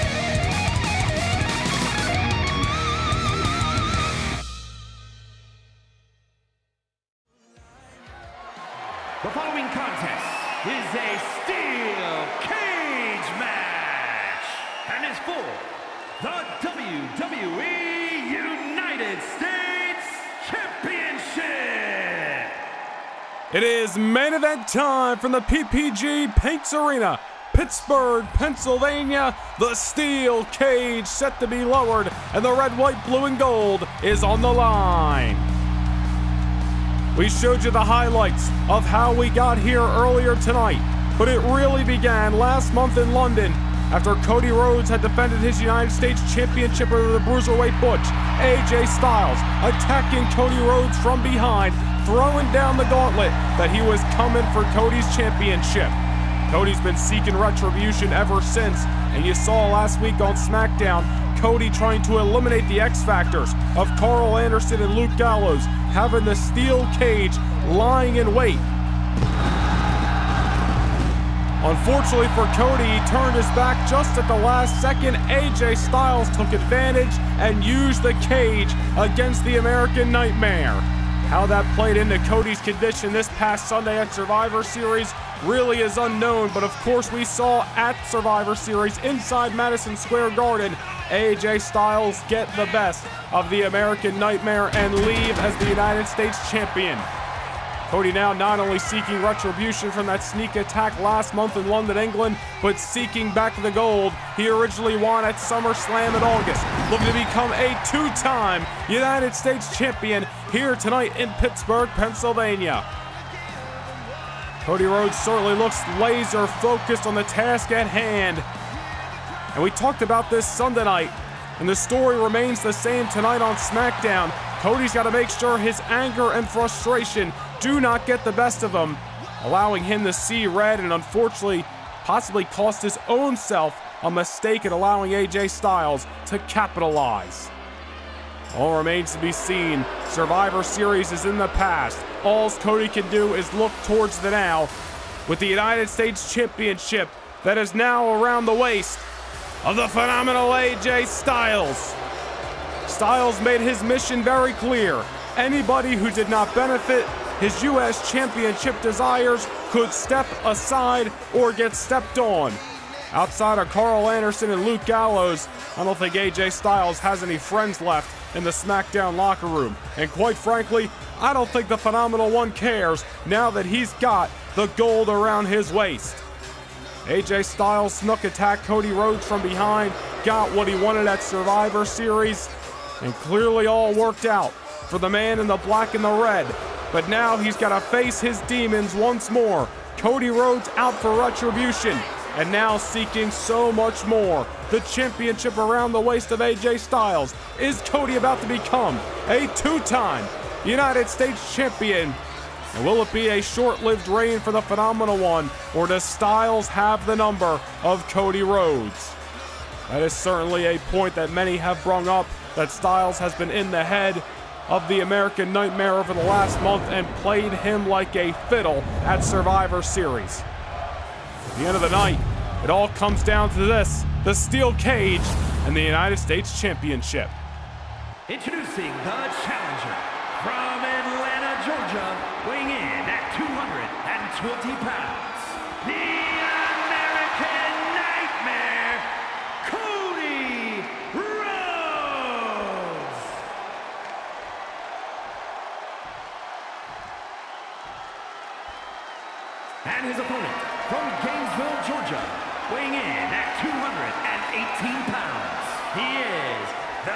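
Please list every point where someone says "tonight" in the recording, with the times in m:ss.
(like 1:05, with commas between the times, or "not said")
0:40, 1:50, 2:03.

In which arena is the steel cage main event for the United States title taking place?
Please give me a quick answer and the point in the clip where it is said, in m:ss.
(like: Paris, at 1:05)
PPG Paints Arena, at 0:25.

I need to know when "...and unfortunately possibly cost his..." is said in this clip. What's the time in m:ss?
2:10.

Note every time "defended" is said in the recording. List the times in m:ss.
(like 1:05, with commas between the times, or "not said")
0:44.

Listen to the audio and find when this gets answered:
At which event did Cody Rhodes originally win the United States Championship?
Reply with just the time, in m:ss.
1:45.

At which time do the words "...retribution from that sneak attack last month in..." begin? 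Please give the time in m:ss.
1:39.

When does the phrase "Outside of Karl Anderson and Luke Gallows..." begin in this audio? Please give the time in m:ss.
2:43.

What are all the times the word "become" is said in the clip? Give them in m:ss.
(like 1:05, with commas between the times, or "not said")
1:47, 3:18.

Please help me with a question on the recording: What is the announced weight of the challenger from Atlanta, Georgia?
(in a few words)
220 pounds.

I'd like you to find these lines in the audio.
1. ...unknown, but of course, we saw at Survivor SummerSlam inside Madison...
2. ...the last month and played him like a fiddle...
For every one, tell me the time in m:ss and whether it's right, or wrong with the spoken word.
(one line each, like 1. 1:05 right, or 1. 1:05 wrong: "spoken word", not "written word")
1. 1:25 wrong: "Series", not "SummerSlam"
2. 3:36 right.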